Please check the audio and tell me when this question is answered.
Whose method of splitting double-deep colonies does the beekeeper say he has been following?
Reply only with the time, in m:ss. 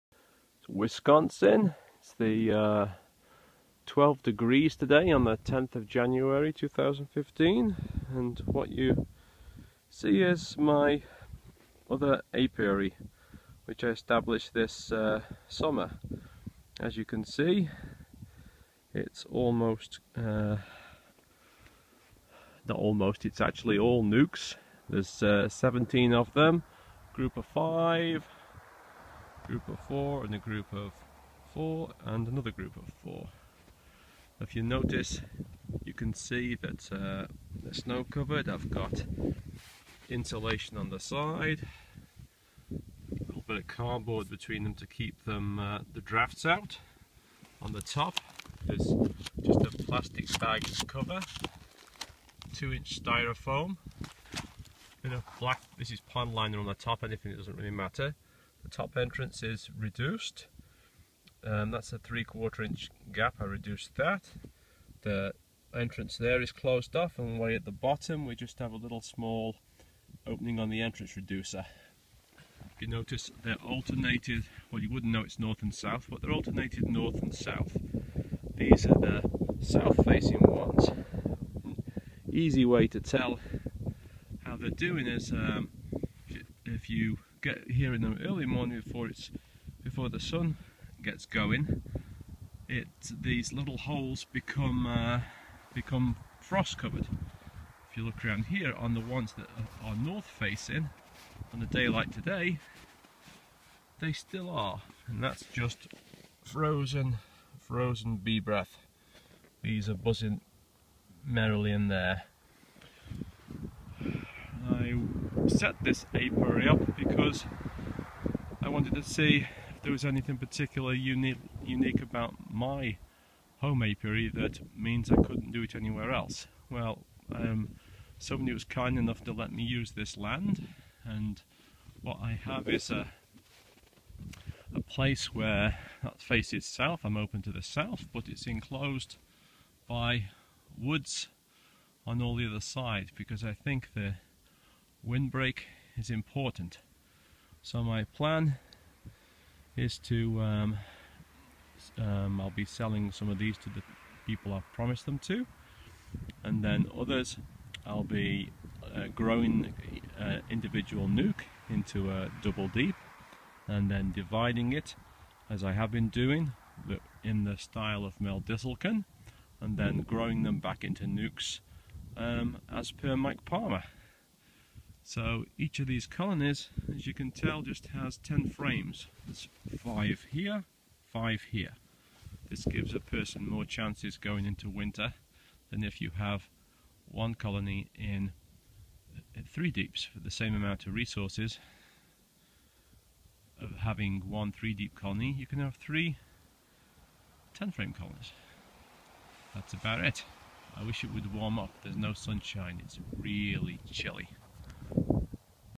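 2:48.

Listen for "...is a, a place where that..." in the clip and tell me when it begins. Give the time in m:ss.
2:12.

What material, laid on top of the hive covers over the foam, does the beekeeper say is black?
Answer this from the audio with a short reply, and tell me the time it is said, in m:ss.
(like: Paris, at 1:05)
pond liner, at 0:56.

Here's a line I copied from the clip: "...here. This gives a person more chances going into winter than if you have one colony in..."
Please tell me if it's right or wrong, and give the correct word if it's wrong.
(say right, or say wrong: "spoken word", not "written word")
right.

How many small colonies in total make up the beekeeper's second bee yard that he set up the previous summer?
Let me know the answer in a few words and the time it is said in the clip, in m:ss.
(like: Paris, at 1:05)
17, at 0:25.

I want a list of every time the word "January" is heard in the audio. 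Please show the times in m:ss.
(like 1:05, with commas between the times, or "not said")
0:05.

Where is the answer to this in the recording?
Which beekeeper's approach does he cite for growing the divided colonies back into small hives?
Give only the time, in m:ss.
2:53.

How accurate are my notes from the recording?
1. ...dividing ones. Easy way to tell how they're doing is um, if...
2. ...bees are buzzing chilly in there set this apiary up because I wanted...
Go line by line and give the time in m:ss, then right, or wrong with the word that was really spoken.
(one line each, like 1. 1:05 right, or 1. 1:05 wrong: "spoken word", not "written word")
1. 1:20 wrong: "facing", not "dividing"
2. 1:49 wrong: "merrily", not "chilly".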